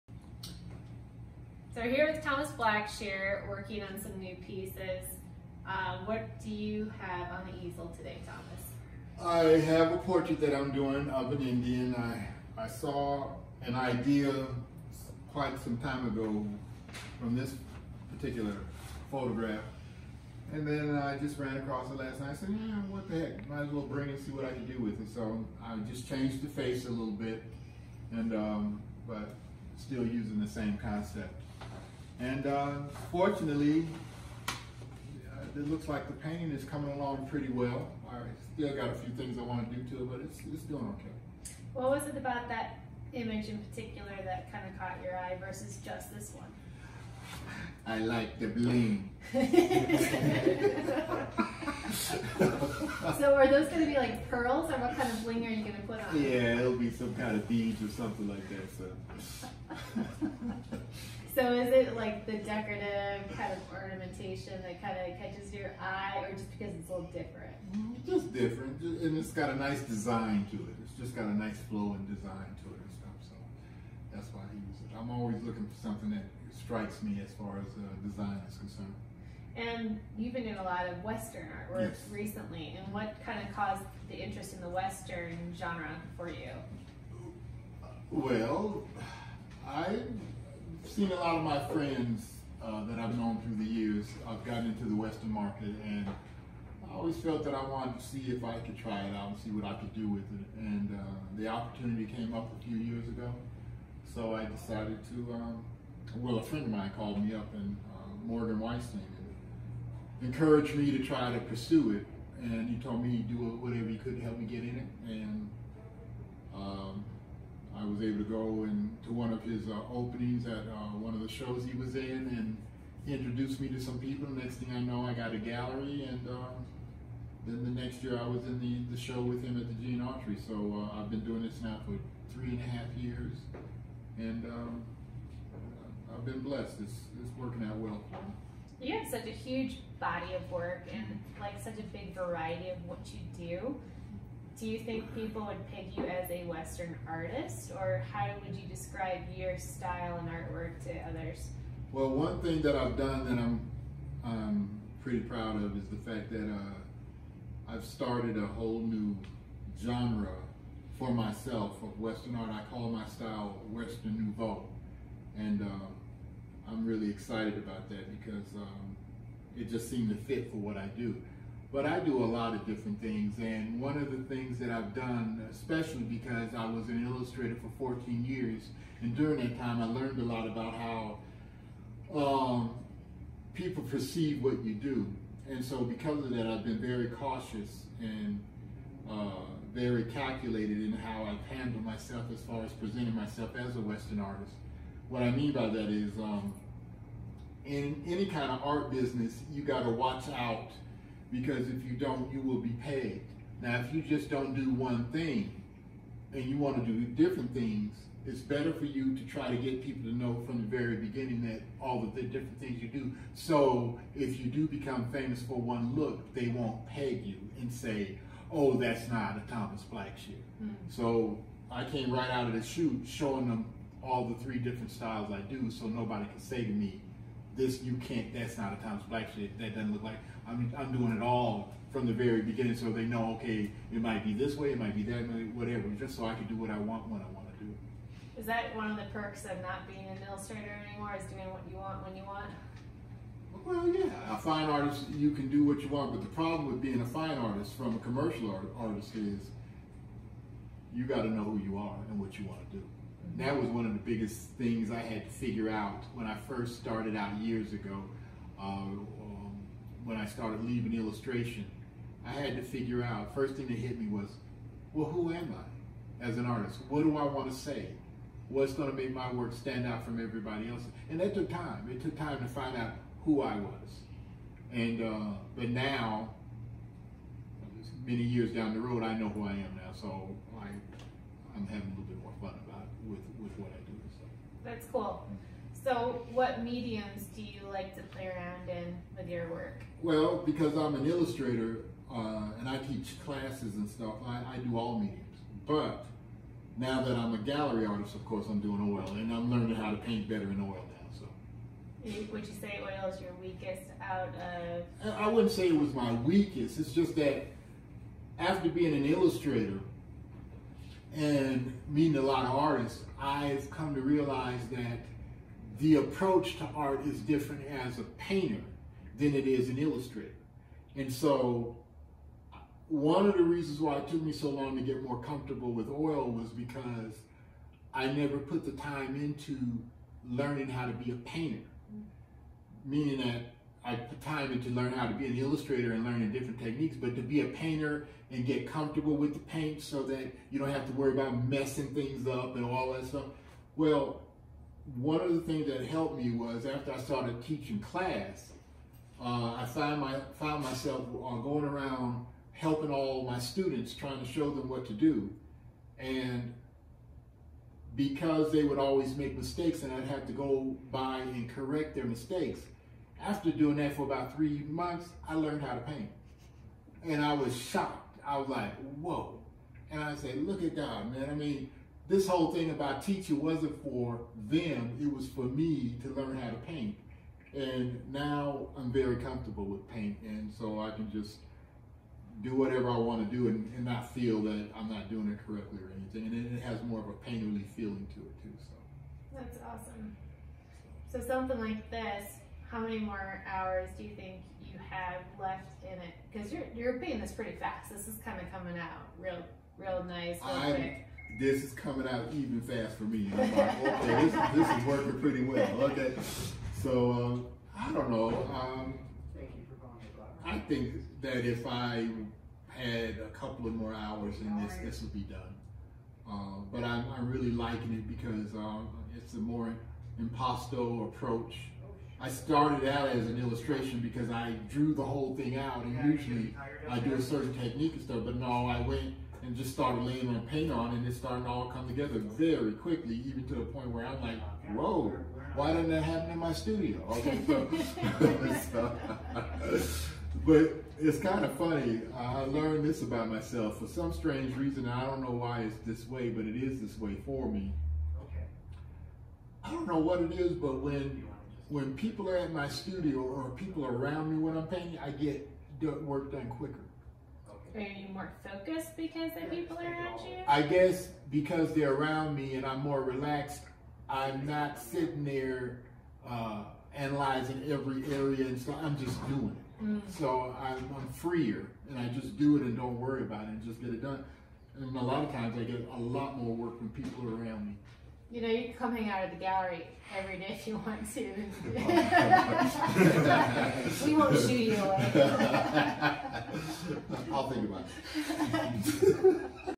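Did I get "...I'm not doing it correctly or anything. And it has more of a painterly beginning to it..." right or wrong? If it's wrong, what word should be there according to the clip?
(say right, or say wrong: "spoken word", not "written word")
wrong: "feeling", not "beginning".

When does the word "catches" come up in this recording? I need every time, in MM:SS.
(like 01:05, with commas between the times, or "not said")
01:05.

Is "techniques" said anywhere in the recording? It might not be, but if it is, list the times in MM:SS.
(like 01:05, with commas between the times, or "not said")
05:36, 07:07.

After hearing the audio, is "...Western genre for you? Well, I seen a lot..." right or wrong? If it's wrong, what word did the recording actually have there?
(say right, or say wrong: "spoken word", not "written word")
right.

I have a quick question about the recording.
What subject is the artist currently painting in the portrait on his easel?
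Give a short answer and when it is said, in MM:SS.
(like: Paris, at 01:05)
An Indian, at 00:11.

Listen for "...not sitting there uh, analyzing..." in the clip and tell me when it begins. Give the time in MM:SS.
07:44.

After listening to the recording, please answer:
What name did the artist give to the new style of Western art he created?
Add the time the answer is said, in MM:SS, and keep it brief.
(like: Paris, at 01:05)
Western Nouveau, at 02:43.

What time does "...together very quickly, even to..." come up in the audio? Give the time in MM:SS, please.
07:11.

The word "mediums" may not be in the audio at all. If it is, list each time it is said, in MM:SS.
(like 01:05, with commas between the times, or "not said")
04:46, 04:54.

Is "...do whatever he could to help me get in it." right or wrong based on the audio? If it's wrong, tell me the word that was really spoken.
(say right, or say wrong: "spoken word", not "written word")
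right.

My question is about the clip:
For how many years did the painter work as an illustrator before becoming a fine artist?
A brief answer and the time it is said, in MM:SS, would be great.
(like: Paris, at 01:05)
14, at 02:57.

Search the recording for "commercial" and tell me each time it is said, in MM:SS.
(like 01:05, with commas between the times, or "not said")
04:07.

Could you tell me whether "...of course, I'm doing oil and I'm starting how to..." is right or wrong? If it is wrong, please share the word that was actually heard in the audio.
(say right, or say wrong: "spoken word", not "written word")
wrong: "learning", not "starting".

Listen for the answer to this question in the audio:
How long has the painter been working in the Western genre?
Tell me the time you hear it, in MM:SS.
02:12.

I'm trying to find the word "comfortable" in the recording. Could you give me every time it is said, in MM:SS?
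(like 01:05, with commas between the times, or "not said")
05:25, 05:38, 06:19.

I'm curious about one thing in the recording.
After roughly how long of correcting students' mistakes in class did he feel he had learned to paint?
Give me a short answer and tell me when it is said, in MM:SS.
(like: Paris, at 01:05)
3 months, at 06:04.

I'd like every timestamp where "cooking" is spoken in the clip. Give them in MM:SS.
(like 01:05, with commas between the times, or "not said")
not said.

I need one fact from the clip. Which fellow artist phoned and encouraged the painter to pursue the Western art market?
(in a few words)
Morgan Weistling.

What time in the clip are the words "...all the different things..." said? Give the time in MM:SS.
03:31.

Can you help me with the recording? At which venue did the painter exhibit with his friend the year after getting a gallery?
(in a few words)
Gene Autry.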